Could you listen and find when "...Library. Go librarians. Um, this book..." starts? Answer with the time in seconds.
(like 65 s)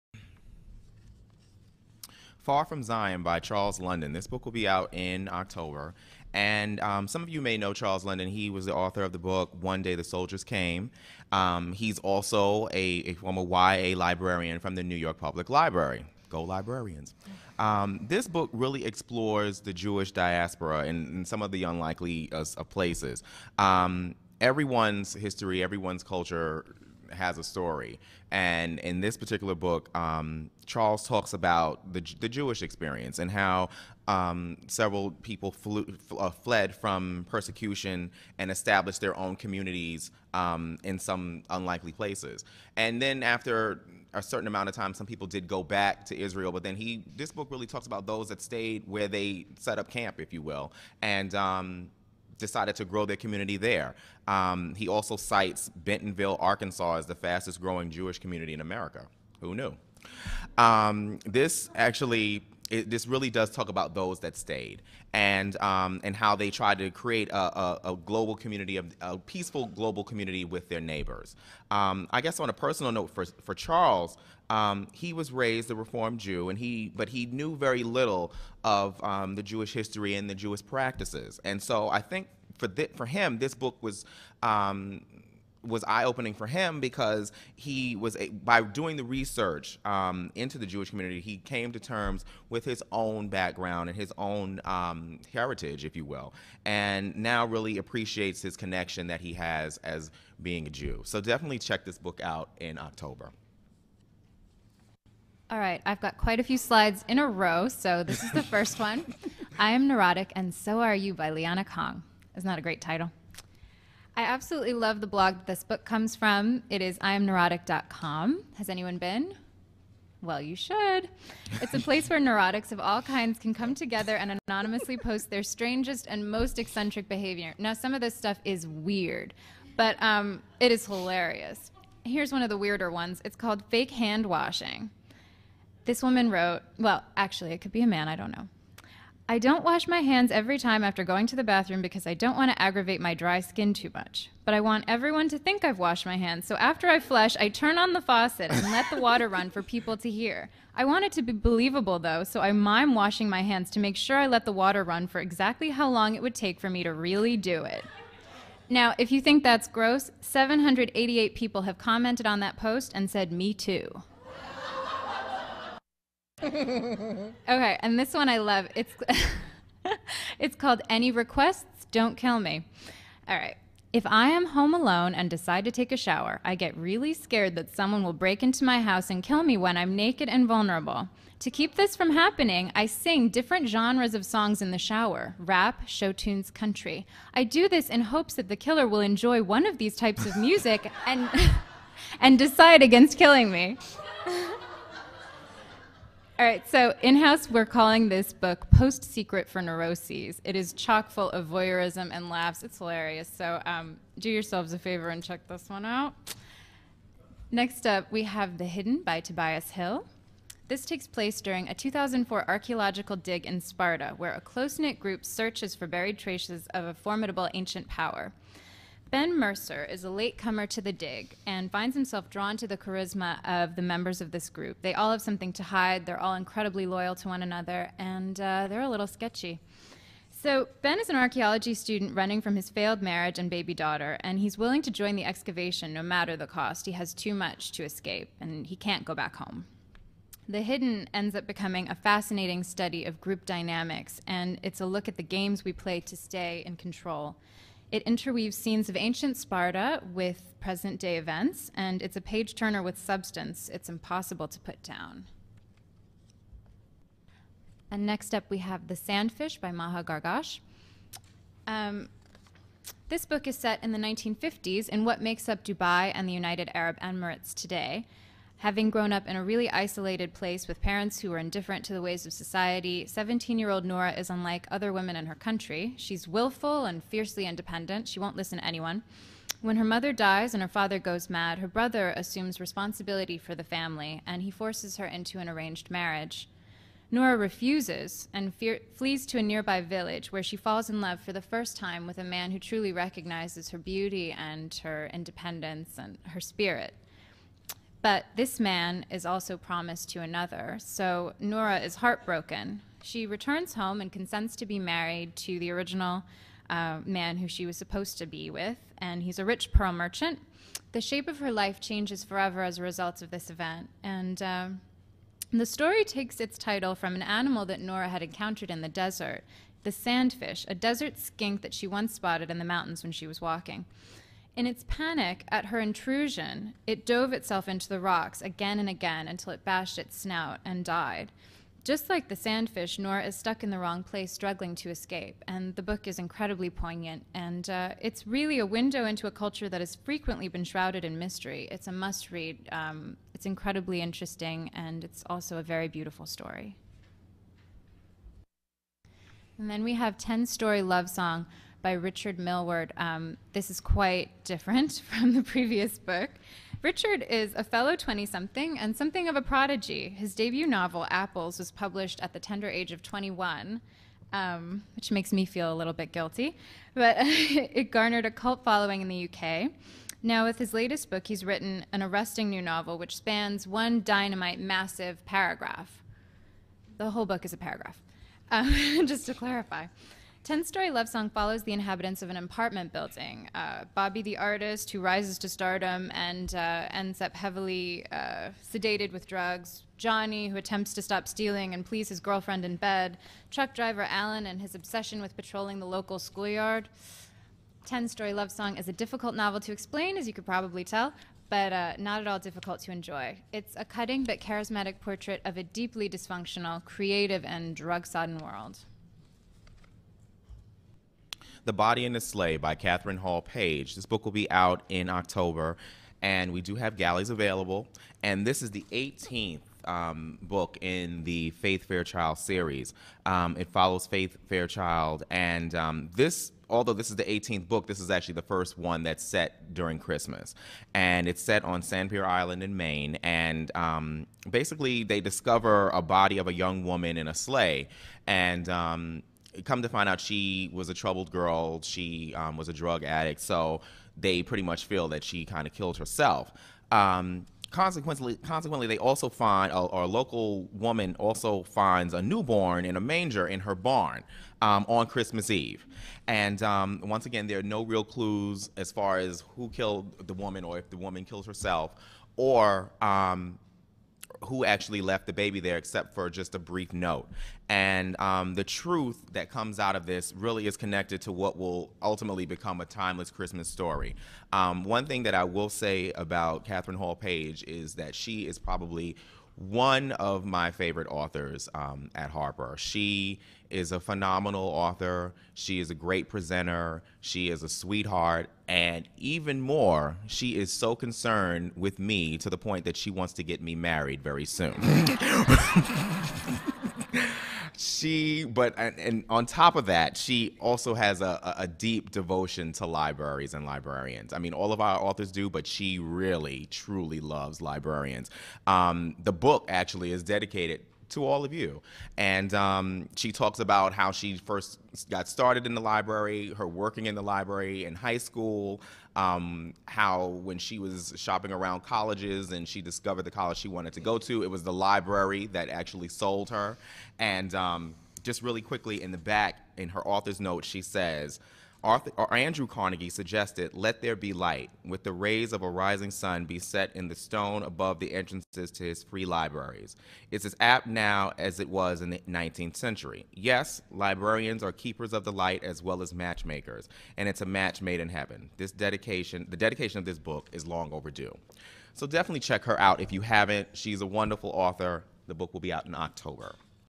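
15 s.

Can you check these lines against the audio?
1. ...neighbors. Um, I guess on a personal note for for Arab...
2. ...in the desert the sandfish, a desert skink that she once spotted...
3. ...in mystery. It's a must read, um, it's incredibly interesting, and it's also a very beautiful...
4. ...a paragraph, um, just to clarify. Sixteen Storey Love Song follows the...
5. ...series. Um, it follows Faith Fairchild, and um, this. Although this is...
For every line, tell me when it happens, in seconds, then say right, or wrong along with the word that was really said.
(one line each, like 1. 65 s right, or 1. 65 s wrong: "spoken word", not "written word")
1. 70 s wrong: "Charles", not "Arab"
2. 318 s right
3. 341 s right
4. 377 s wrong: "Ten", not "Sixteen"
5. 422 s right.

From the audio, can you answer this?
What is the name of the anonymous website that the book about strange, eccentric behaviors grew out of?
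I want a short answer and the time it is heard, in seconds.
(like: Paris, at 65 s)
imneurotic.com, at 116 s.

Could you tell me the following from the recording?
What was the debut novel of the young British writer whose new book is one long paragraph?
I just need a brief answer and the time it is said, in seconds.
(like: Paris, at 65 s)
Apples, at 361 s.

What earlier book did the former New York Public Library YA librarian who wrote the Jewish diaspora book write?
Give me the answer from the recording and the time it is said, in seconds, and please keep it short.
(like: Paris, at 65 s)
One Day the Soldiers Came, at 9 s.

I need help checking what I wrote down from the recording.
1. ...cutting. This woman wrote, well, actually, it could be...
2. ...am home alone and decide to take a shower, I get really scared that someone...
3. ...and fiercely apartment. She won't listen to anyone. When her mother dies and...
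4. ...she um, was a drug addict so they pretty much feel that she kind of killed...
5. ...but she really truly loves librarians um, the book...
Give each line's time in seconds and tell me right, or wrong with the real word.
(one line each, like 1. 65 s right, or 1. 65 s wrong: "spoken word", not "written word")
1. 134 s wrong: "washing", not "cutting"
2. 174 s right
3. 276 s wrong: "independent", not "apartment"
4. 441 s right
5. 505 s right.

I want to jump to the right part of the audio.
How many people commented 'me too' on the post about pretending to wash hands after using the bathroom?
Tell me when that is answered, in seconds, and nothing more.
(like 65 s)
160 s.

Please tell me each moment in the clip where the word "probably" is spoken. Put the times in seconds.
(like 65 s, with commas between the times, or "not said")
400 s, 478 s.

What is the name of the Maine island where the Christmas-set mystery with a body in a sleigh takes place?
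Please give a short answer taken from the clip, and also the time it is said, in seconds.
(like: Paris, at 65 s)
Sanpere Island, at 431 s.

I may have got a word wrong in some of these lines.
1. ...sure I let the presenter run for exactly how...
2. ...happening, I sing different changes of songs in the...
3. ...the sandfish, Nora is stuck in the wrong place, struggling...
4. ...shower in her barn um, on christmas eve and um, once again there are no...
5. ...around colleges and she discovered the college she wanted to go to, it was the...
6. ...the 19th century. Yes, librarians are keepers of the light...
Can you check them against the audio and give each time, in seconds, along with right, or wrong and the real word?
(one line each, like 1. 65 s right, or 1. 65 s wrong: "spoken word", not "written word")
1. 153 s wrong: "water", not "presenter"
2. 182 s wrong: "genres", not "changes"
3. 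332 s right
4. 453 s wrong: "manger", not "shower"
5. 521 s right
6. 542 s right.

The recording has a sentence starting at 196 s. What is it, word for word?
All right, so in house, we're calling this book Post Secret for Neuroses.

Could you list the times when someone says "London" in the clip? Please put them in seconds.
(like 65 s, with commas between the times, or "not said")
3 s, 8 s.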